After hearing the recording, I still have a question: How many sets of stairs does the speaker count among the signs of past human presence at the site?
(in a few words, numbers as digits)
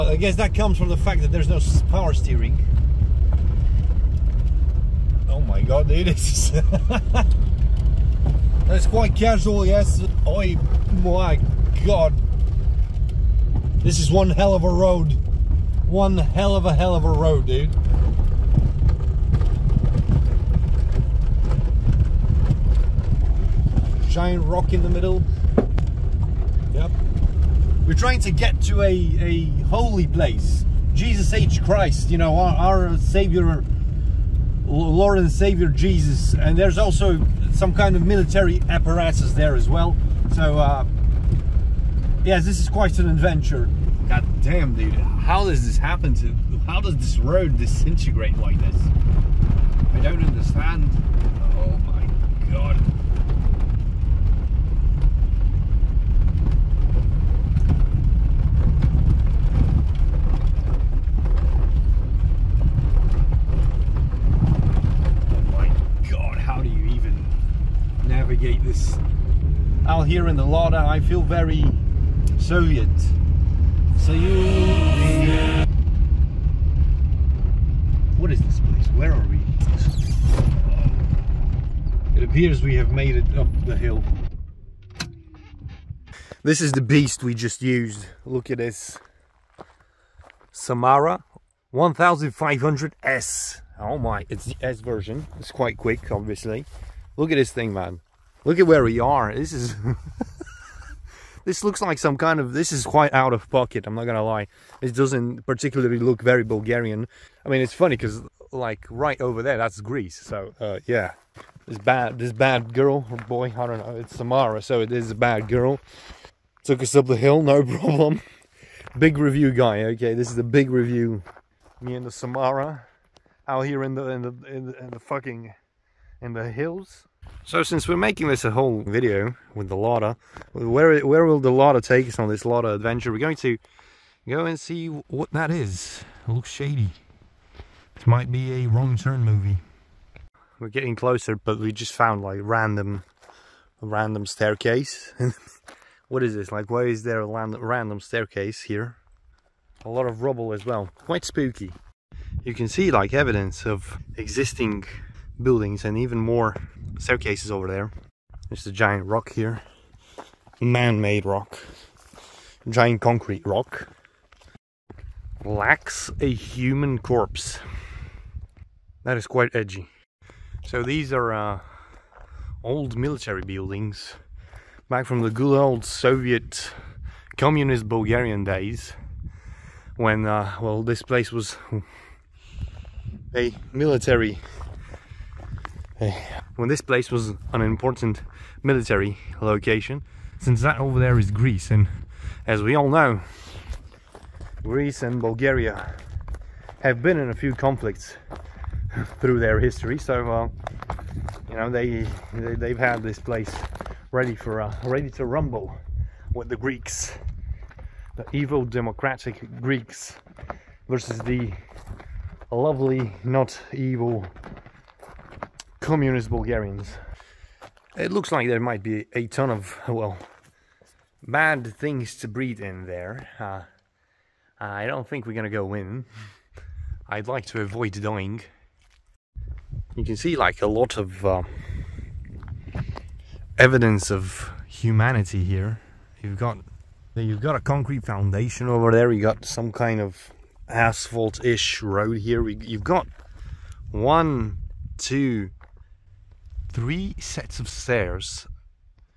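3.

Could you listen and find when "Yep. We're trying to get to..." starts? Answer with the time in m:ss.
0:26.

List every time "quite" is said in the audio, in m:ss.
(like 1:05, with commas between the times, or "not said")
0:08, 0:42, 1:35, 1:42, 2:30, 2:49.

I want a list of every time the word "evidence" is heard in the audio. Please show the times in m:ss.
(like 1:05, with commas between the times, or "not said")
2:33, 3:53.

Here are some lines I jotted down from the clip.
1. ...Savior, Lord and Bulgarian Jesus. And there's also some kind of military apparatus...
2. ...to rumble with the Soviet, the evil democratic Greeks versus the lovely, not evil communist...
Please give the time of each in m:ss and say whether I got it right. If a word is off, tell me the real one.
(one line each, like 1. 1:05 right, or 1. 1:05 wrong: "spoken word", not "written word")
1. 0:32 wrong: "Savior", not "Bulgarian"
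2. 3:25 wrong: "Greeks", not "Soviet".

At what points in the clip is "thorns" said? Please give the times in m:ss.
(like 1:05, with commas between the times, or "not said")
not said.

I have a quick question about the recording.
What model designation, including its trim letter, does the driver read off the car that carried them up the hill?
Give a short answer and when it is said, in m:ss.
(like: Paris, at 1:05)
Samara 1500S, at 1:30.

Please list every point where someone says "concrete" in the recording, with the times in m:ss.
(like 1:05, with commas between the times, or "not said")
2:43, 3:57.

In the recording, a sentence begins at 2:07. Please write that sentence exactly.
So since we're making this a whole video with the Lada, where where will the Lada take us on this Lada adventure?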